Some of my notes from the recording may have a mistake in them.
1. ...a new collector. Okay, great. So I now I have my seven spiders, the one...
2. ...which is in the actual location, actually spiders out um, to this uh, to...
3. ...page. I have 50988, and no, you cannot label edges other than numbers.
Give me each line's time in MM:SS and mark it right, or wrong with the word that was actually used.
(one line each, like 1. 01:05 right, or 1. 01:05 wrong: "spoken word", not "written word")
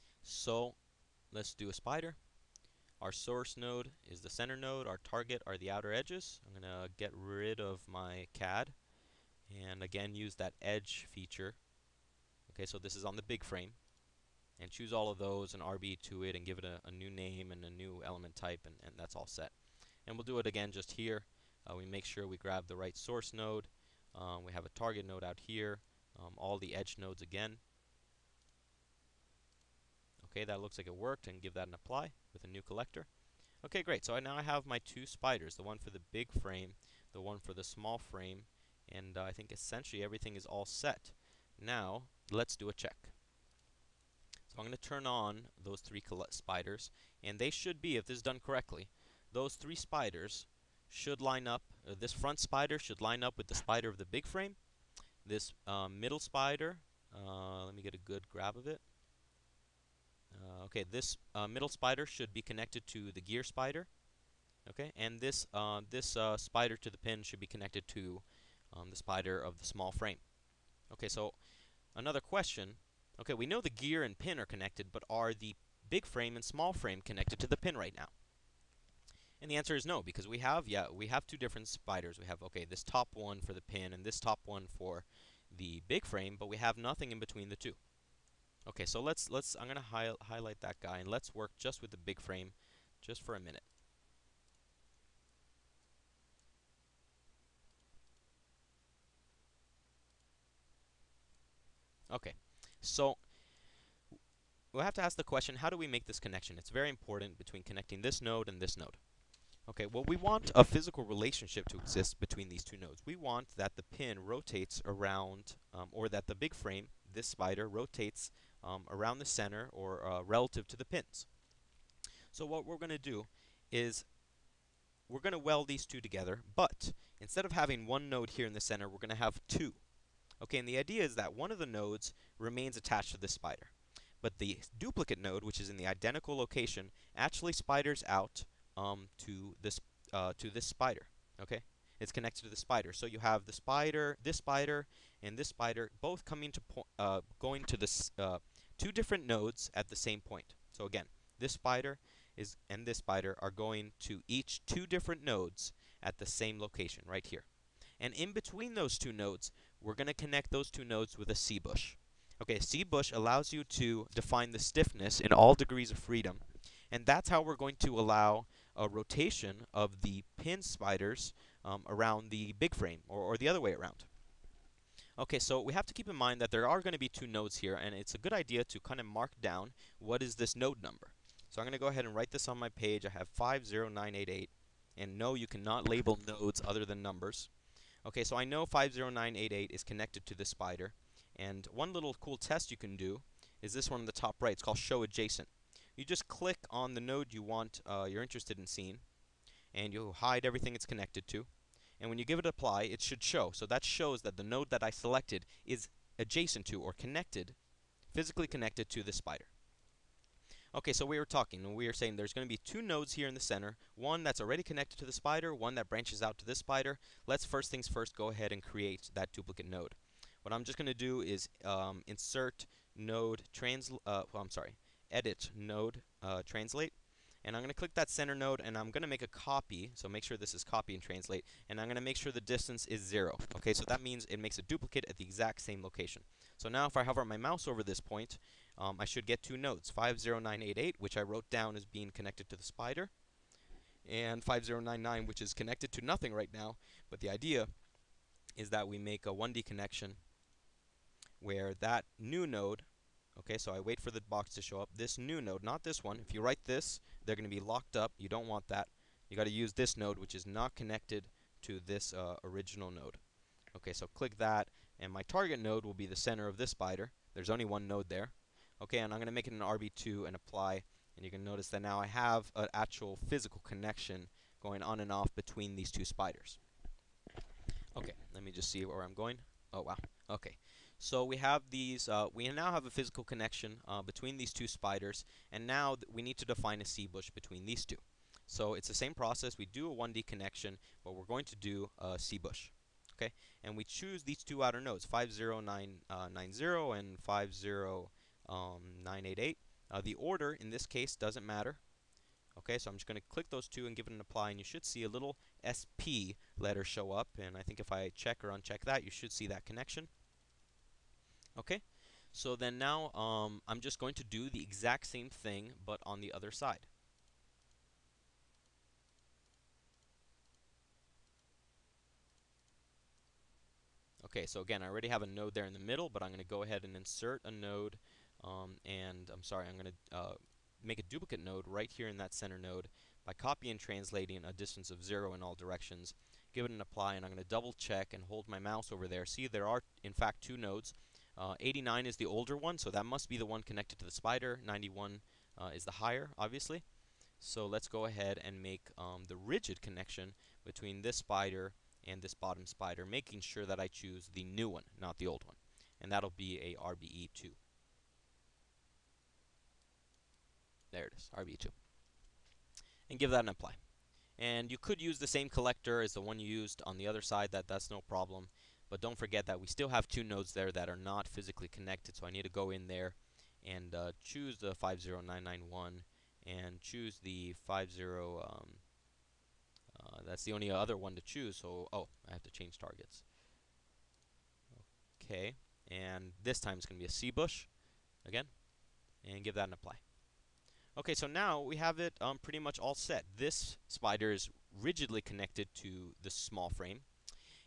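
1. 00:32 wrong: "two", not "seven"
2. 02:15 wrong: "identical", not "actual"
3. 03:02 wrong: "nodes", not "edges".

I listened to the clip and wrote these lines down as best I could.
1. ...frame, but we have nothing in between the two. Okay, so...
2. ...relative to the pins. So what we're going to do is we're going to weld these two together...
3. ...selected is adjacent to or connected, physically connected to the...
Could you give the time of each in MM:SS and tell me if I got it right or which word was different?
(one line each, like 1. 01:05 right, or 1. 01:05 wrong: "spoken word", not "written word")
1. 01:26 right
2. 02:00 right
3. 03:24 right.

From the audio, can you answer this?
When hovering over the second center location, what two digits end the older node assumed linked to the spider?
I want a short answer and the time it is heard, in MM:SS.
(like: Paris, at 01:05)
89, at 05:41.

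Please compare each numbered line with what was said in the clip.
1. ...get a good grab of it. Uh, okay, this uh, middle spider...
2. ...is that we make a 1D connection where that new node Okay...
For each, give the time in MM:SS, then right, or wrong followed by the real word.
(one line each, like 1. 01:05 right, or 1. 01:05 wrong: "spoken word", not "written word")
1. 00:57 right
2. 04:08 right.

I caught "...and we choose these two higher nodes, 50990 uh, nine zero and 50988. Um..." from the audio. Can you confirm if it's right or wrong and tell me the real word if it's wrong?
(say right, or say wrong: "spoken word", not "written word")
wrong: "outer", not "higher".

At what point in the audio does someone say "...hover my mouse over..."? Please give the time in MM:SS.
03:57.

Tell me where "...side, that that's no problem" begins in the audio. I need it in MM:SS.
06:07.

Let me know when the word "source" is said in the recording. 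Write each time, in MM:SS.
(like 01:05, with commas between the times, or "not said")
00:03, 00:22.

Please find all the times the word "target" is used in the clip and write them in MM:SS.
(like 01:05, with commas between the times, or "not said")
00:05, 00:24, 04:25, 06:22.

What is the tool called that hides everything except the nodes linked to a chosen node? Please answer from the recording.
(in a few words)
show adjacent.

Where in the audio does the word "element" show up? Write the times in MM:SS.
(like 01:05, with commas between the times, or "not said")
00:18.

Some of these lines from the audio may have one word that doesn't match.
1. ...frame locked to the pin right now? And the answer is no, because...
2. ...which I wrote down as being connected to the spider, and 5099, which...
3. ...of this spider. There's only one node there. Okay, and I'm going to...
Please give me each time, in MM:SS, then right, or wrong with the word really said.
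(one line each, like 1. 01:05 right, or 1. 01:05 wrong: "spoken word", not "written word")
1. 01:16 wrong: "connected", not "locked"
2. 04:00 right
3. 04:26 right.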